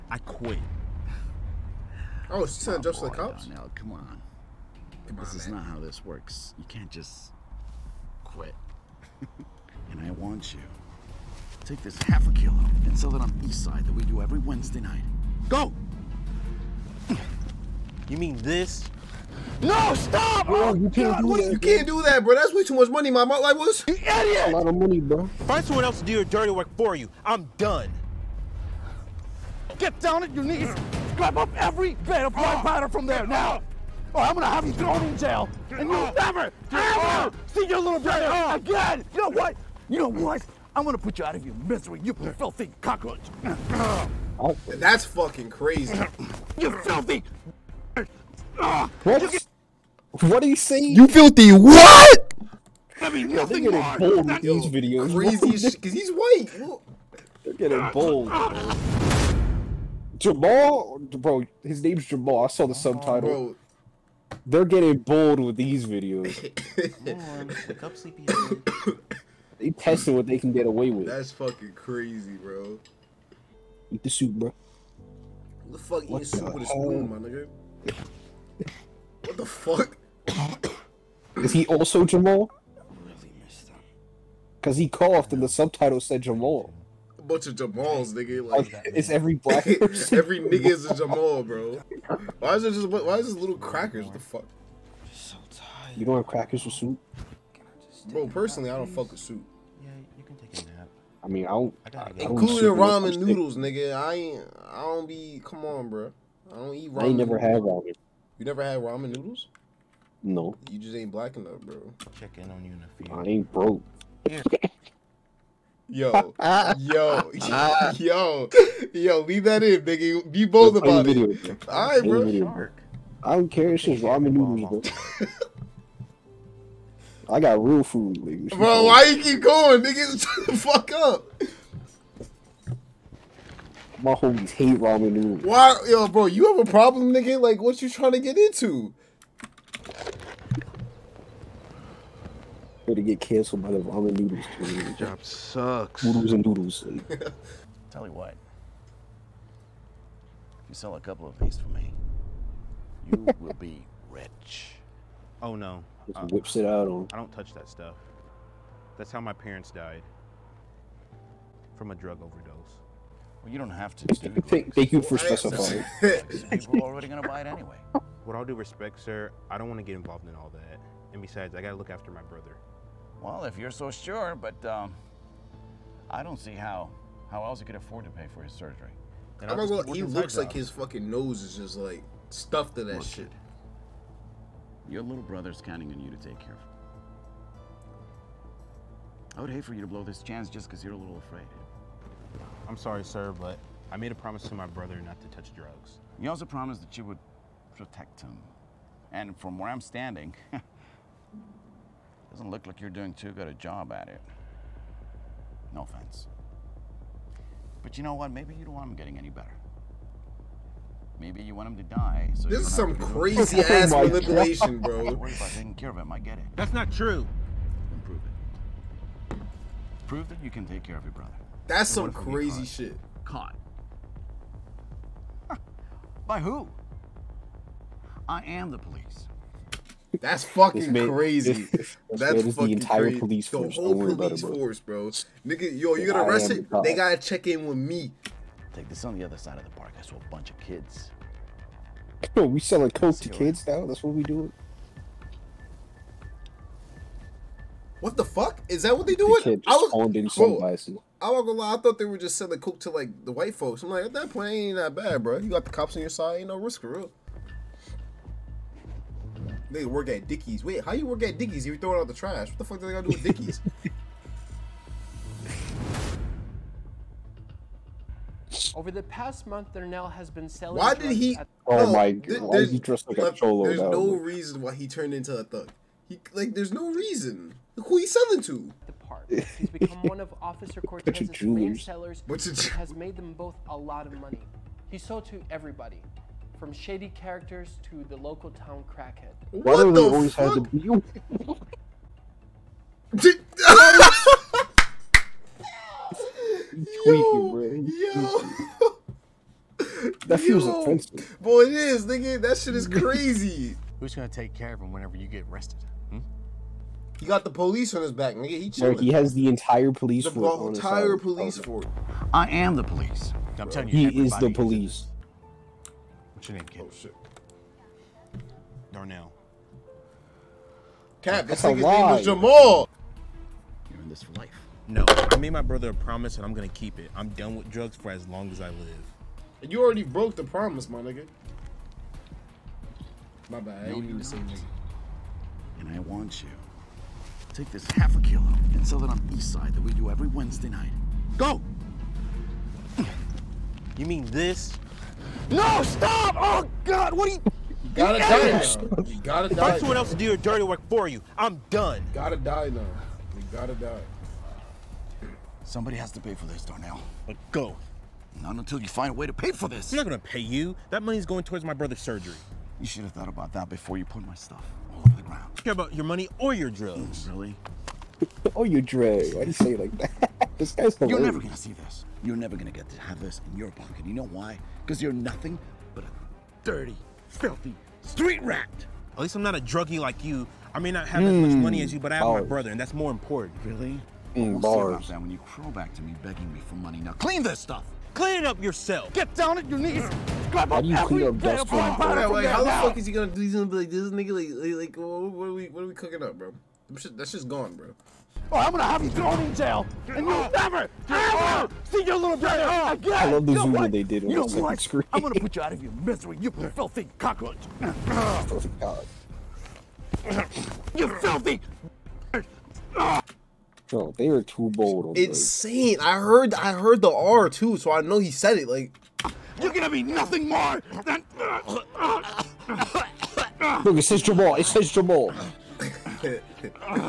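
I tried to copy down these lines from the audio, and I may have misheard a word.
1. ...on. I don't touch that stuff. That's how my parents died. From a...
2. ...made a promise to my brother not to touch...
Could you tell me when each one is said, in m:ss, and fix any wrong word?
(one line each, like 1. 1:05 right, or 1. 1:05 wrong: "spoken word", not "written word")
1. 2:36 right
2. 3:13 right.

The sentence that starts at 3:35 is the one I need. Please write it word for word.
Don't worry about taking care of him.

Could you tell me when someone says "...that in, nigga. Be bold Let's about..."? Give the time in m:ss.
1:59.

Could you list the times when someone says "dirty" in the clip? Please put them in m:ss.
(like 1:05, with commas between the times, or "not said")
0:26, 5:50, 6:16.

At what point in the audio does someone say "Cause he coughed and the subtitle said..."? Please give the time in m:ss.
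1:24.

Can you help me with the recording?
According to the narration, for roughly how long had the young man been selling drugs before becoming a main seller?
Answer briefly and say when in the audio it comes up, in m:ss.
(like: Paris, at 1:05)
The past month, at 4:28.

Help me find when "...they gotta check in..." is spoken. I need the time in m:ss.
3:56.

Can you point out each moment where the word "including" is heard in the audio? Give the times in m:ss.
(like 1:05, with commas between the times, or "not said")
1:42.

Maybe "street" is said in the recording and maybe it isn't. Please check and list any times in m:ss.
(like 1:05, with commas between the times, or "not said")
6:18.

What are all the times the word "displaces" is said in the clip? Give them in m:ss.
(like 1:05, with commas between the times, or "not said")
not said.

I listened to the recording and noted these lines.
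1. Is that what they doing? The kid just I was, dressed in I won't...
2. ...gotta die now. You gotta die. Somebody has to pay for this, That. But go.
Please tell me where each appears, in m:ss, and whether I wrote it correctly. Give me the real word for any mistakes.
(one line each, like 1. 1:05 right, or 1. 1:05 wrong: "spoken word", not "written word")
1. 4:08 wrong: "owned", not "dressed"
2. 5:52 wrong: "Darnell", not "That".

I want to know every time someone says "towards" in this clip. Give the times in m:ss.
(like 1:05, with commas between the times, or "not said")
6:01.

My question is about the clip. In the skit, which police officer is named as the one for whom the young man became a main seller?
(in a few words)
Officer Cortez.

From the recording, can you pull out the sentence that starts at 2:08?
Bro, why you keep going, nigga?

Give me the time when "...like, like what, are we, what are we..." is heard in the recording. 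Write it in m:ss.
6:34.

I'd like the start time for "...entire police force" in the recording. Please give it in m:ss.
5:10.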